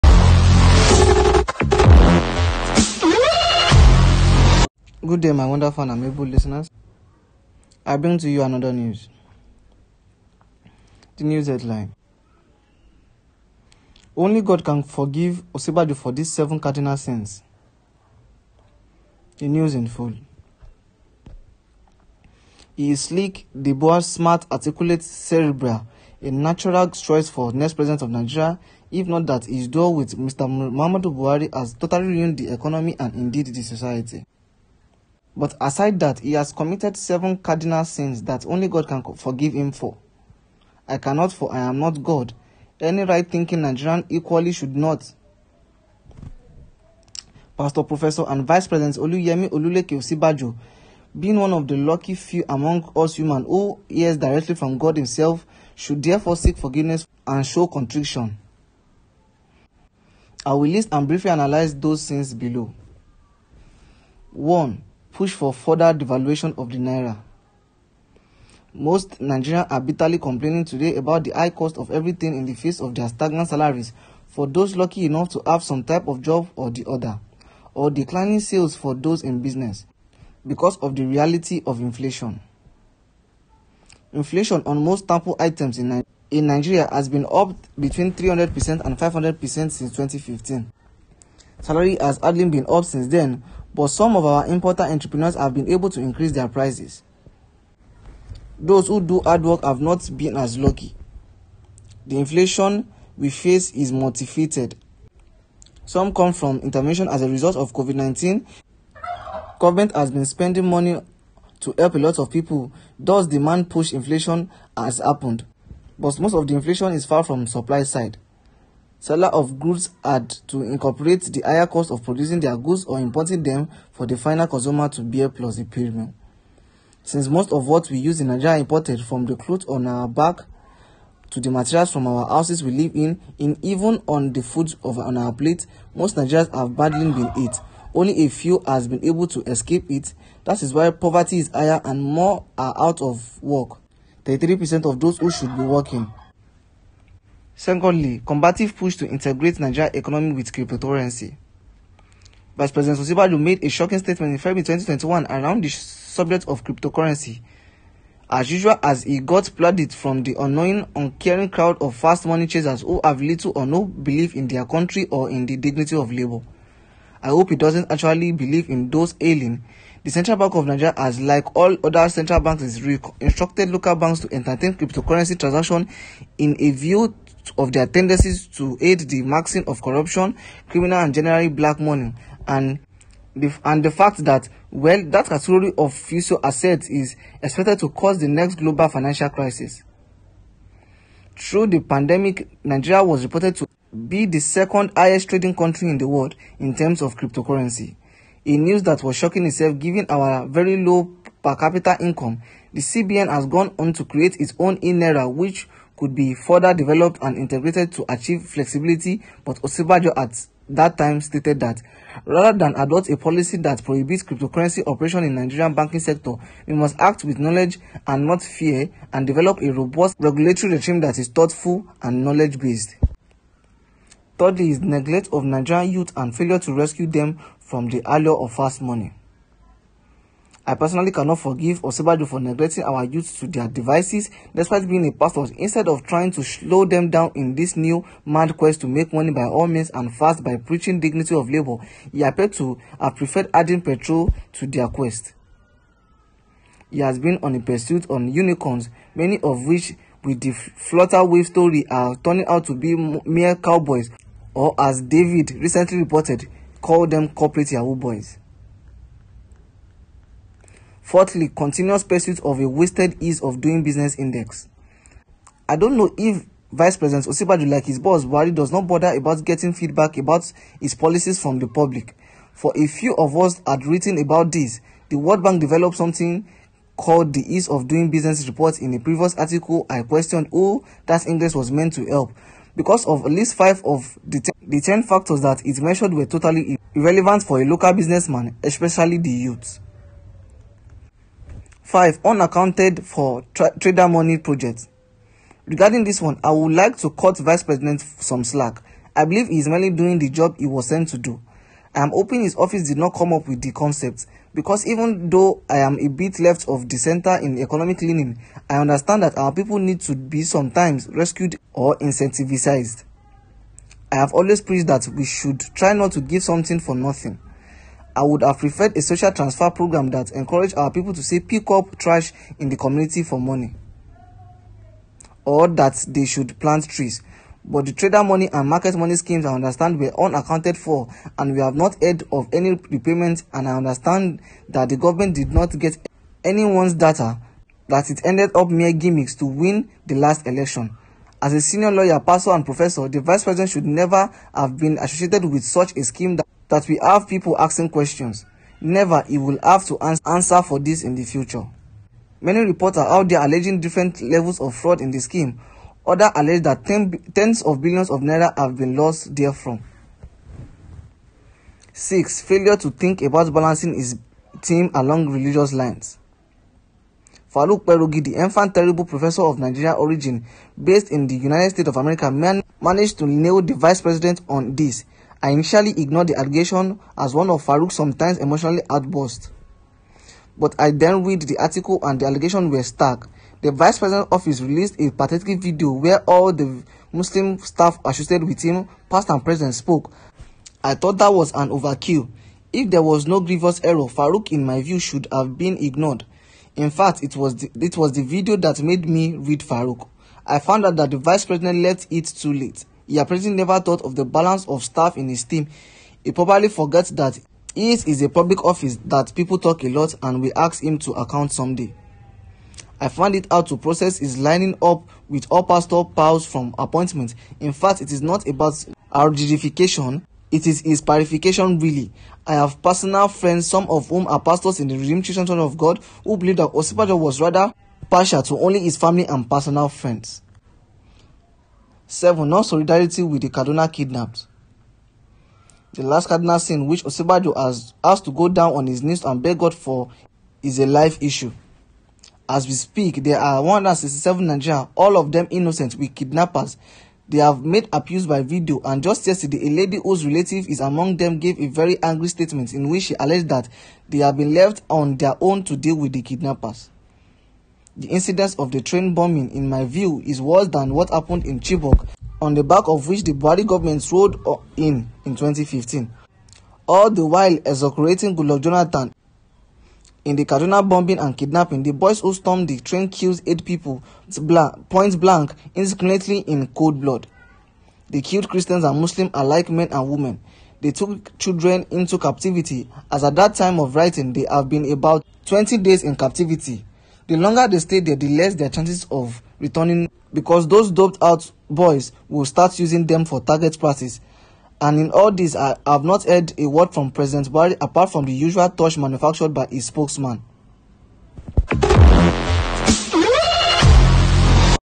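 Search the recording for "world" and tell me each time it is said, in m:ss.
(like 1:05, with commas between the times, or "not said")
3:16, 4:35.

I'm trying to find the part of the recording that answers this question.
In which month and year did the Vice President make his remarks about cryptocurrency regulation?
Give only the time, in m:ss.
2:34.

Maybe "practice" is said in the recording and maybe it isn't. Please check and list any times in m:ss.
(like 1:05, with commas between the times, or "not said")
8:13.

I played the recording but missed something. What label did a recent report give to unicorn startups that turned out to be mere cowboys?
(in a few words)
corporate Yahoo boys.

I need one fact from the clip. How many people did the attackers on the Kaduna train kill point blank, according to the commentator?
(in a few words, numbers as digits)
8.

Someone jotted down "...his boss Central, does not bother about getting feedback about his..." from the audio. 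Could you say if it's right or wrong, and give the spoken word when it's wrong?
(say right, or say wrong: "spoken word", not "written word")
wrong: "Buhari", not "Central".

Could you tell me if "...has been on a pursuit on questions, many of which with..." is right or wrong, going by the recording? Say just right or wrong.
wrong.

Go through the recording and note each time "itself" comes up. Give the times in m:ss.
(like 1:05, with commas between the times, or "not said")
3:19.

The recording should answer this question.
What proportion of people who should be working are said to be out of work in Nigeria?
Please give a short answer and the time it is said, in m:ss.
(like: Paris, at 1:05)
33%, at 2:24.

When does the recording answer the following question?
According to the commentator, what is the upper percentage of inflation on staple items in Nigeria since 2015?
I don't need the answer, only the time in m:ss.
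1:28.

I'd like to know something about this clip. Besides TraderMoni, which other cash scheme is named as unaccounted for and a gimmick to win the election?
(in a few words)
MarketMoni.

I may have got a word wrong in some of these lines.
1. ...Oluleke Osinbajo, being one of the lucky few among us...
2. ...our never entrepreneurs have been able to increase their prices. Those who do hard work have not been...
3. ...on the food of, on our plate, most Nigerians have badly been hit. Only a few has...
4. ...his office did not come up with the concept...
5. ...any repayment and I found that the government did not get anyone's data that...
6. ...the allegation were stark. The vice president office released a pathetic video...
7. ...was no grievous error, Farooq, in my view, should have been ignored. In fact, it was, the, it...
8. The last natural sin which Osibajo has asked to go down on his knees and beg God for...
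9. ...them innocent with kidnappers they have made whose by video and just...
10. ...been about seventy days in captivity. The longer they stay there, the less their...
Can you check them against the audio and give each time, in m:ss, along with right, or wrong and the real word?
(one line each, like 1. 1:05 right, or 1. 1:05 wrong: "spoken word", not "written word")
1. 0:49 right
2. 1:34 wrong: "importer", not "never"
3. 2:14 right
4. 5:02 right
5. 5:32 wrong: "understand", not "found"
6. 6:22 right
7. 6:33 right
8. 7:15 wrong: "cardinal", not "natural"
9. 7:25 wrong: "abuse", not "whose"
10. 8:04 wrong: "twenty", not "seventy".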